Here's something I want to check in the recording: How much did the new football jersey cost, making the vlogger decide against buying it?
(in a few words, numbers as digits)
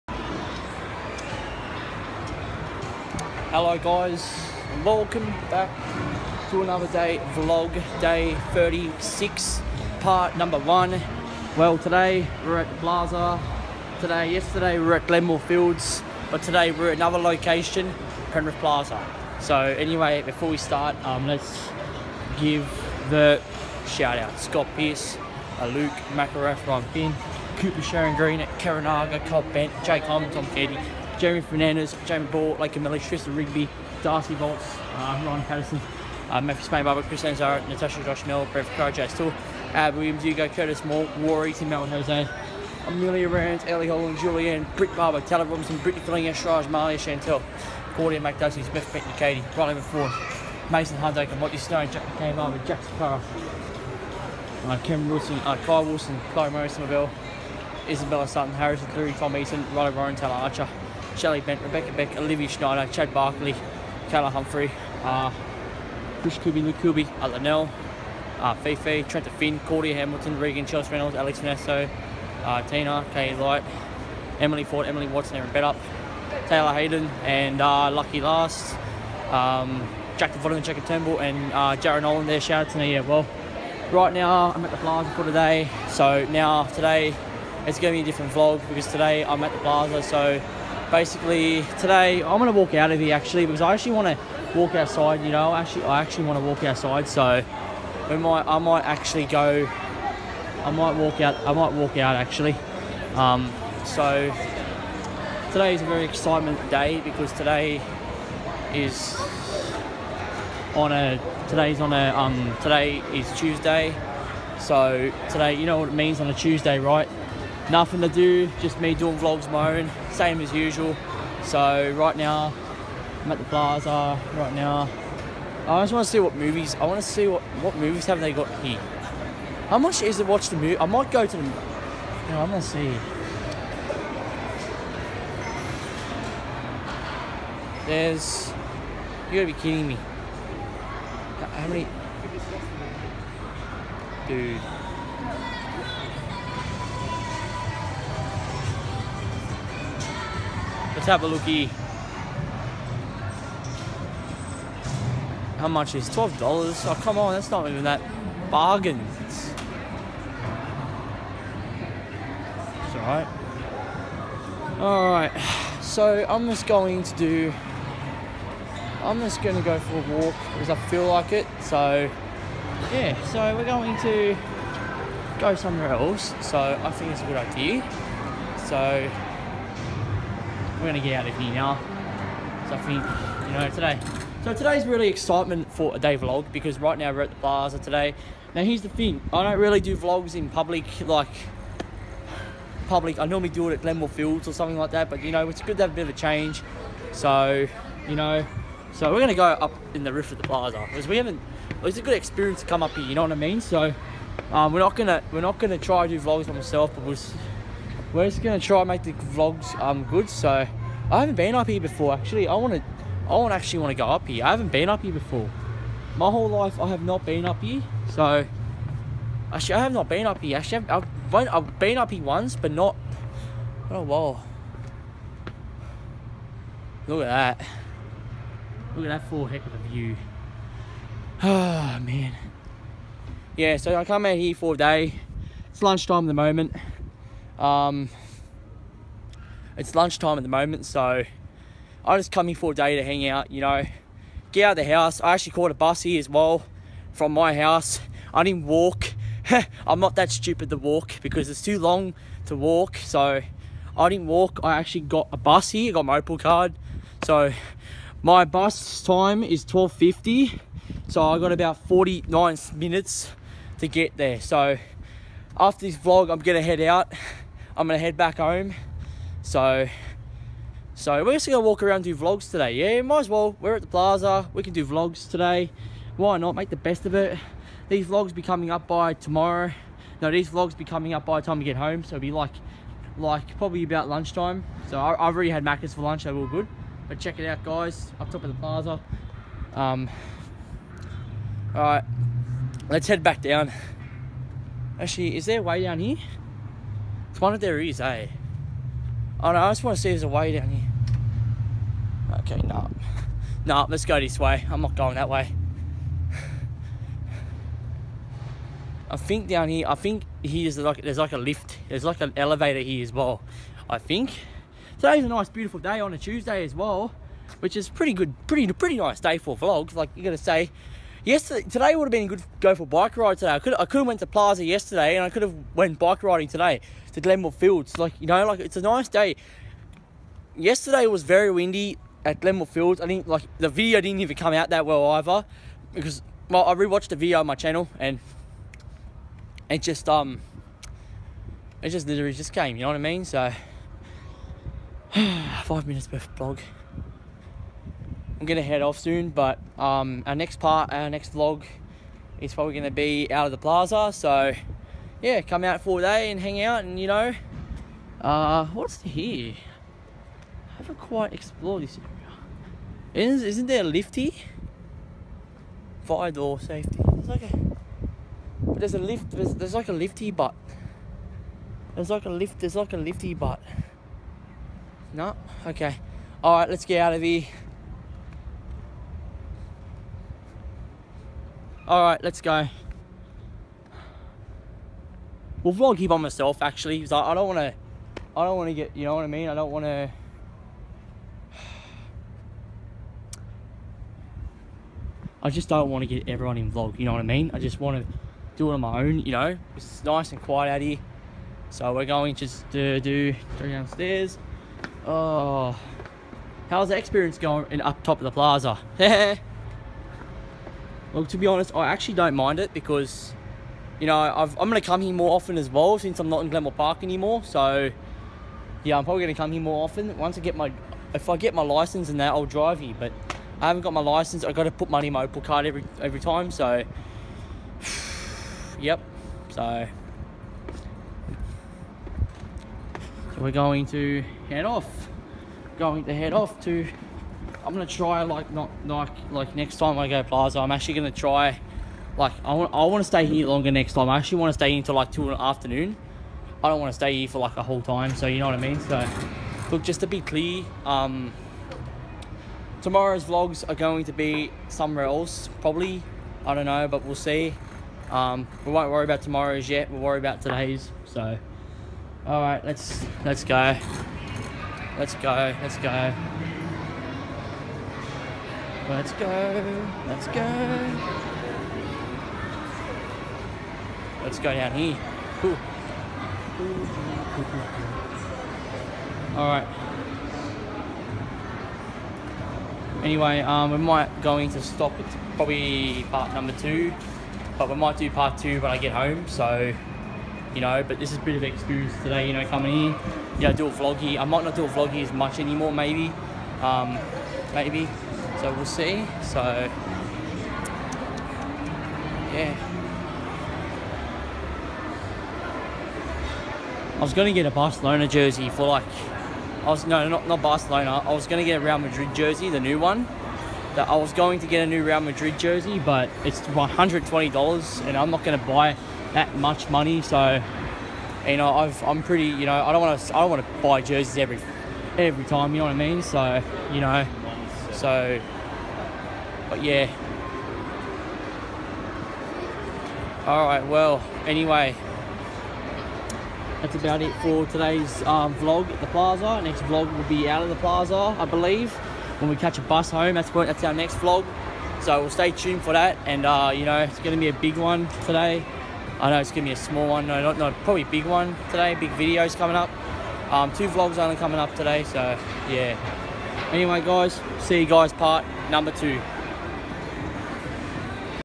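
$120.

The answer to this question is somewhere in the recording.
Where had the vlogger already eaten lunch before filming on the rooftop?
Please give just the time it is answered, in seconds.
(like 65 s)
285 s.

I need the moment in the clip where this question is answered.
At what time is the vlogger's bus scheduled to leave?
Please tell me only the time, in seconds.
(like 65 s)
259 s.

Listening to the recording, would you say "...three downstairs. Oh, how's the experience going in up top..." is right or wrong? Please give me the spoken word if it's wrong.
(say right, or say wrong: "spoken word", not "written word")
right.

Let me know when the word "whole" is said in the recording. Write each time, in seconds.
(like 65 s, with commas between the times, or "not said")
216 s, 447 s.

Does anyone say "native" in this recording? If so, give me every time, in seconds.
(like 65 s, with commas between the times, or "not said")
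not said.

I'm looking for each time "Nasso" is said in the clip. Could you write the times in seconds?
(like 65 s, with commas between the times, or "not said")
71 s.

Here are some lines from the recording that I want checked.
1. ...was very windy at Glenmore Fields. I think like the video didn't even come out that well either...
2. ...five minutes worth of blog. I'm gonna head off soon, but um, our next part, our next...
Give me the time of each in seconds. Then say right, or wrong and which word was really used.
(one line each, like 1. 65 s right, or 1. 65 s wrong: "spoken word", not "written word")
1. 331 s right
2. 345 s right.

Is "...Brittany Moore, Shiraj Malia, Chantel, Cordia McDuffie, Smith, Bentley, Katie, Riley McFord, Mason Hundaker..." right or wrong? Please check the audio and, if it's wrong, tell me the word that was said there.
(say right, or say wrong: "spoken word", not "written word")
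wrong: "Fillinger", not "Moore".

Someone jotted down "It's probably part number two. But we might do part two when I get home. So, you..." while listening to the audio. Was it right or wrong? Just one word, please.
right.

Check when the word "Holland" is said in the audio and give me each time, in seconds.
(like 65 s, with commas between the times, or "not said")
43 s.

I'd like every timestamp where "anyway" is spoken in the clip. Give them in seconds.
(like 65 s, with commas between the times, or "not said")
19 s, 483 s, 534 s, 556 s.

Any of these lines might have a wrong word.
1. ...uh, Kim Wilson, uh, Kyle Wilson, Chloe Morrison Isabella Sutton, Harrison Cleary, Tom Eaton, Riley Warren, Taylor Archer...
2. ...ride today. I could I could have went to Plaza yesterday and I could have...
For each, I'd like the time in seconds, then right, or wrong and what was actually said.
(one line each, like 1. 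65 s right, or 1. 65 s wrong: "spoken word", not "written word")
1. 54 s right
2. 323 s right.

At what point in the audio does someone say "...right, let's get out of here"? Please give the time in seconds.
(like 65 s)
376 s.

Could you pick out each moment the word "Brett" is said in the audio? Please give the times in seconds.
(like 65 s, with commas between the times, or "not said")
38 s.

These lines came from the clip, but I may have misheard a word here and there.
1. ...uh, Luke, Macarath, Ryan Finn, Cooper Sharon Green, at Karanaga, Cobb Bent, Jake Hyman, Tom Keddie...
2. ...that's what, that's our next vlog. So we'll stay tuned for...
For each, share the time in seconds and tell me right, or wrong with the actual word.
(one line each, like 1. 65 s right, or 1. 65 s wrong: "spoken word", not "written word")
1. 25 s right
2. 543 s right.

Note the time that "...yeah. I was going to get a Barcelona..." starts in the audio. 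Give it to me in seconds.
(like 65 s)
502 s.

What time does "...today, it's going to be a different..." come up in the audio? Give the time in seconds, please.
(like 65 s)
86 s.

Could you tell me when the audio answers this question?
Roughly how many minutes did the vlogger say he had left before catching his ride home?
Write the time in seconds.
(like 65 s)
261 s.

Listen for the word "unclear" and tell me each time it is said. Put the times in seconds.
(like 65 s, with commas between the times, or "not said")
not said.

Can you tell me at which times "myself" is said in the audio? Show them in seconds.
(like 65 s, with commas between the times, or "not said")
206 s, 386 s.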